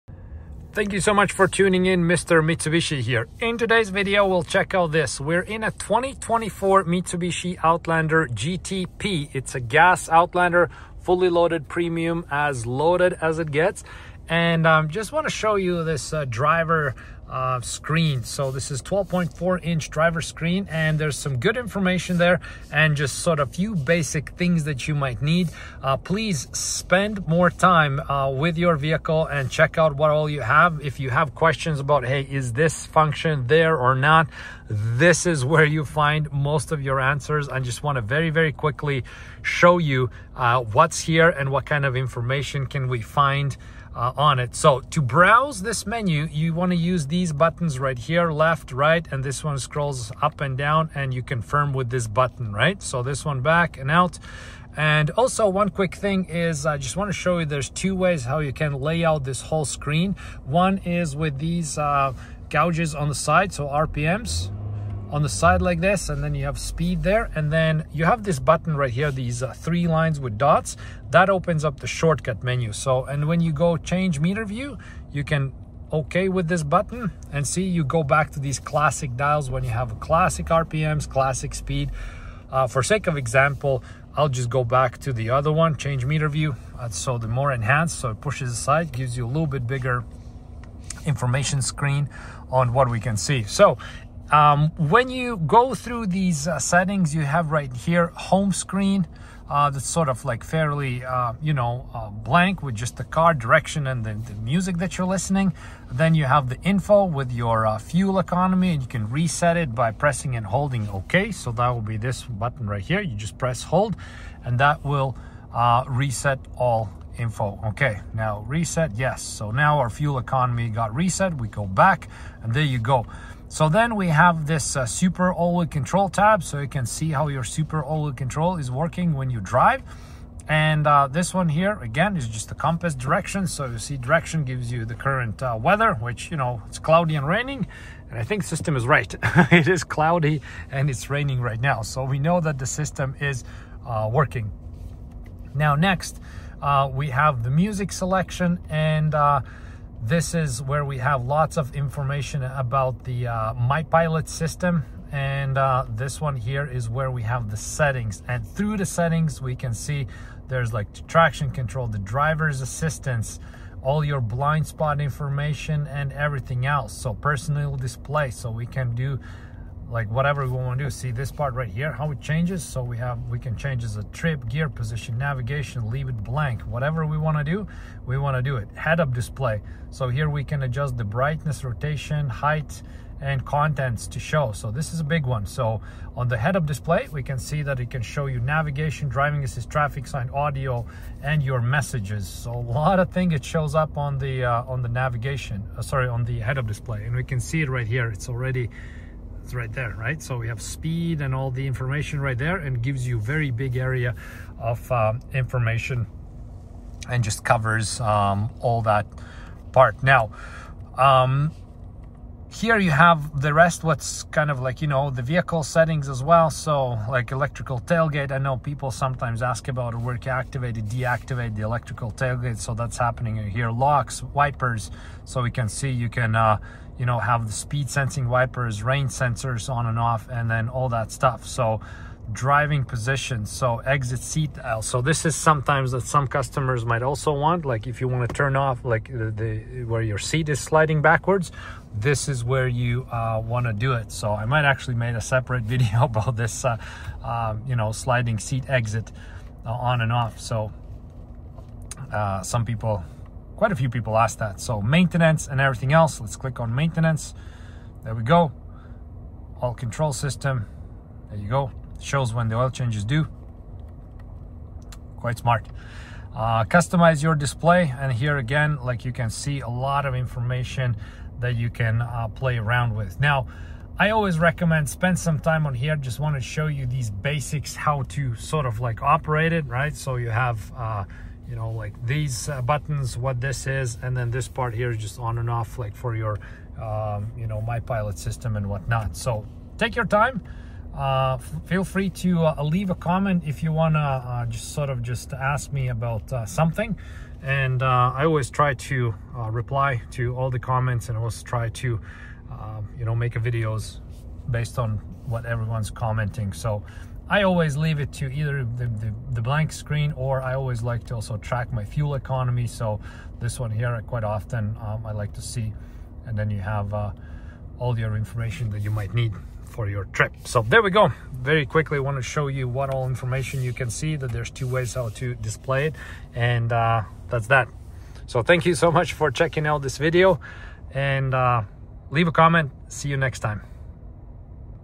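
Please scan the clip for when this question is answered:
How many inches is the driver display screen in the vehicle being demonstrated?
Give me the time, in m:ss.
0:18.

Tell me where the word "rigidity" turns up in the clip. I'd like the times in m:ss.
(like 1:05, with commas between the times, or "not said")
not said.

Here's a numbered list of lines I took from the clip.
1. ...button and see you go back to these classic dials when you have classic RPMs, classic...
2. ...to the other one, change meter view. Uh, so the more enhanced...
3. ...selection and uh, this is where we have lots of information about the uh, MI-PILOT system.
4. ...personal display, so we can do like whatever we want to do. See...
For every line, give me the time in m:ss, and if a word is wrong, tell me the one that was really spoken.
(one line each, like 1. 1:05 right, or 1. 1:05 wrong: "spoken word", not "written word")
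1. 1:16 right
2. 1:24 right
3. 2:27 right
4. 2:47 right.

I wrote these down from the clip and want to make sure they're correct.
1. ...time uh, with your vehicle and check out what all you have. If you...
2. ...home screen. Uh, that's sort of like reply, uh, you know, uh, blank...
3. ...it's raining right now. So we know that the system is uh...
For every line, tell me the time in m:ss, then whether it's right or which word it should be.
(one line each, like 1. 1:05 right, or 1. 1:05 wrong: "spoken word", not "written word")
1. 0:27 right
2. 1:38 wrong: "fairly", not "reply"
3. 2:20 right.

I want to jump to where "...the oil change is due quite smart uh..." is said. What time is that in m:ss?
4:22.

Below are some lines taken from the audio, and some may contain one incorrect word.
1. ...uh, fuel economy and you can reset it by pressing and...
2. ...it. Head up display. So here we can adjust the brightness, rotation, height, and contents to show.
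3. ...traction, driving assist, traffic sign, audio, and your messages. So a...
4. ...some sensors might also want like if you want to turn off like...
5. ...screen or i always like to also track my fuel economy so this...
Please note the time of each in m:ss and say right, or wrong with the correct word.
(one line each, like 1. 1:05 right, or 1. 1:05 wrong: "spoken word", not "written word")
1. 1:47 right
2. 2:58 right
3. 3:08 wrong: "navigation", not "traction"
4. 3:56 wrong: "customers", not "sensors"
5. 5:09 right.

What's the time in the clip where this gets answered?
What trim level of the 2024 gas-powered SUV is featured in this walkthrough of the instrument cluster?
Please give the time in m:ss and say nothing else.
0:08.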